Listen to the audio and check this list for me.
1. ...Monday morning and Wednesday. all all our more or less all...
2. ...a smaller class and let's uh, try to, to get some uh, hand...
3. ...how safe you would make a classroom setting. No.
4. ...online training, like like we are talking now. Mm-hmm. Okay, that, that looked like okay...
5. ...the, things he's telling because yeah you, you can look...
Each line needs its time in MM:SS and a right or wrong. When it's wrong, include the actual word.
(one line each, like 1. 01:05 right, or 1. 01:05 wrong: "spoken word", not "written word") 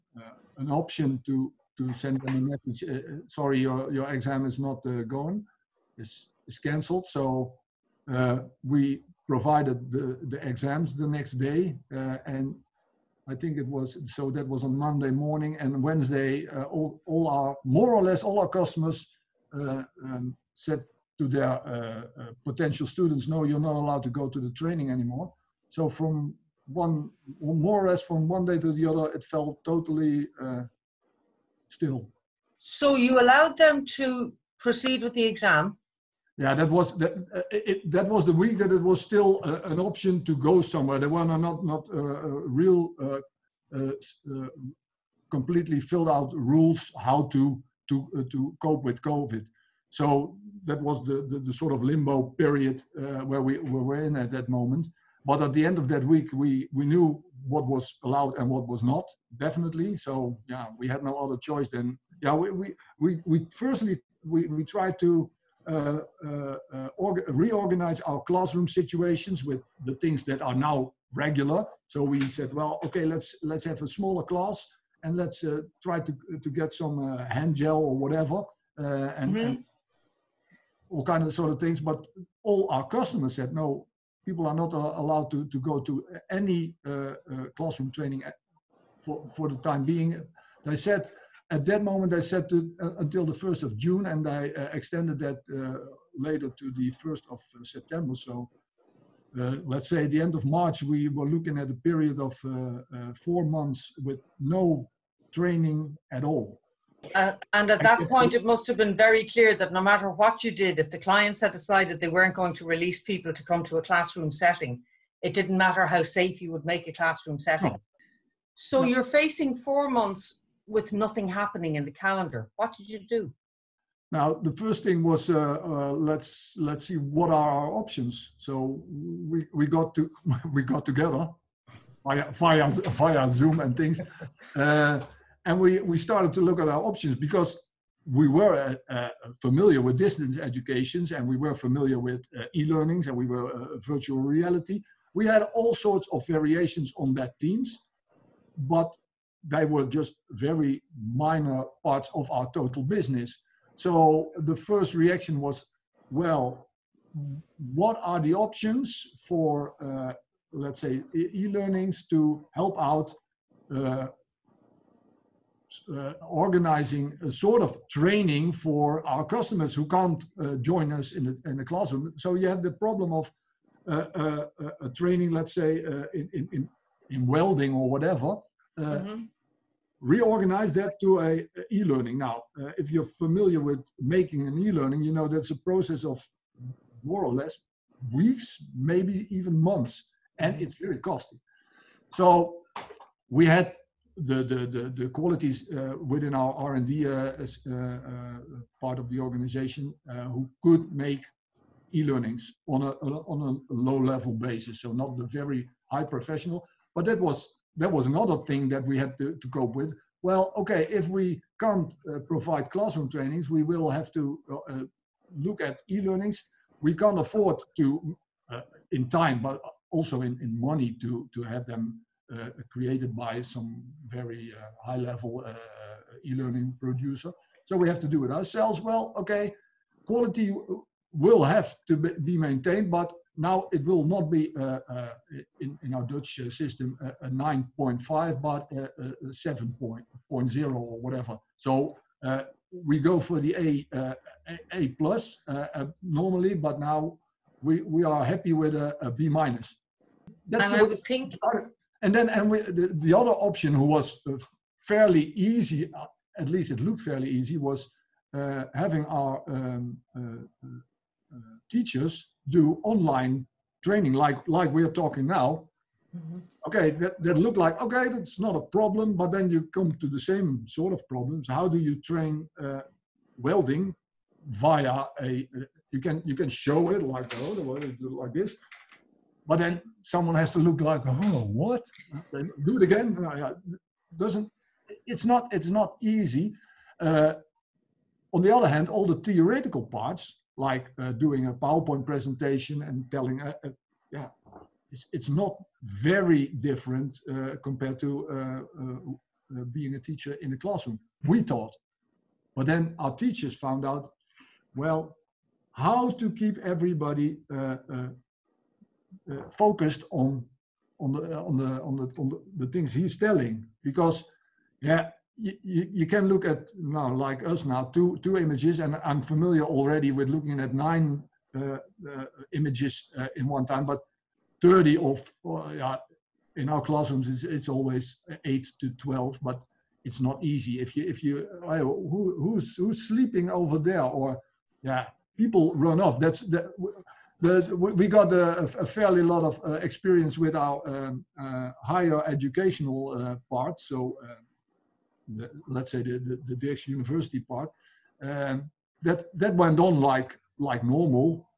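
1. 00:14 right
2. 01:13 right
3. 01:55 right
4. 04:22 right
5. 05:12 right.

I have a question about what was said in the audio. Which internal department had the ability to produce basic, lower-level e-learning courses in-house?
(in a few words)
R&D.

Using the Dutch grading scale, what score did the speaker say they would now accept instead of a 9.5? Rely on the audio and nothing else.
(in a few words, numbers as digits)
7.0.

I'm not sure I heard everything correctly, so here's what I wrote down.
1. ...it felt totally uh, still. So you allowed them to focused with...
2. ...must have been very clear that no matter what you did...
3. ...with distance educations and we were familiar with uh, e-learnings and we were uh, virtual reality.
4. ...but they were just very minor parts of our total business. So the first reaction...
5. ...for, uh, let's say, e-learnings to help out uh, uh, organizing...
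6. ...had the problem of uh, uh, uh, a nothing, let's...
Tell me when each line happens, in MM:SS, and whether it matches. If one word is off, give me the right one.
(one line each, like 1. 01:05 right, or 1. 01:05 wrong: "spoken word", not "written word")
1. 00:29 wrong: "proceed", not "focused"
2. 01:48 right
3. 02:19 right
4. 02:28 right
5. 02:39 right
6. 02:52 wrong: "training", not "nothing".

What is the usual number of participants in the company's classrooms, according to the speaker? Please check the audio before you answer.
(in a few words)
8 to 12.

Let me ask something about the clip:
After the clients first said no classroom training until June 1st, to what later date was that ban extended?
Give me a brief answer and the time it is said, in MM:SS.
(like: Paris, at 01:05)
1st of September, at 01:36.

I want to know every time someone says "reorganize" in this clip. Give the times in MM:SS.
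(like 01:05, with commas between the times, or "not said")
01:07, 03:00.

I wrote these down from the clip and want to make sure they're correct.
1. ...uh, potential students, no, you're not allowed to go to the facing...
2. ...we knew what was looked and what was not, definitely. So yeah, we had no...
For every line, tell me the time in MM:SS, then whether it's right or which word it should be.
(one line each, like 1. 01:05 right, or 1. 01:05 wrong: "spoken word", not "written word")
1. 00:21 wrong: "training", not "facing"
2. 00:56 wrong: "allowed", not "looked".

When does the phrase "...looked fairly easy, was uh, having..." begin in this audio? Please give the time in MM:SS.
04:16.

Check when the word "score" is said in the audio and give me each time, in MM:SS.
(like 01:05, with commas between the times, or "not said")
not said.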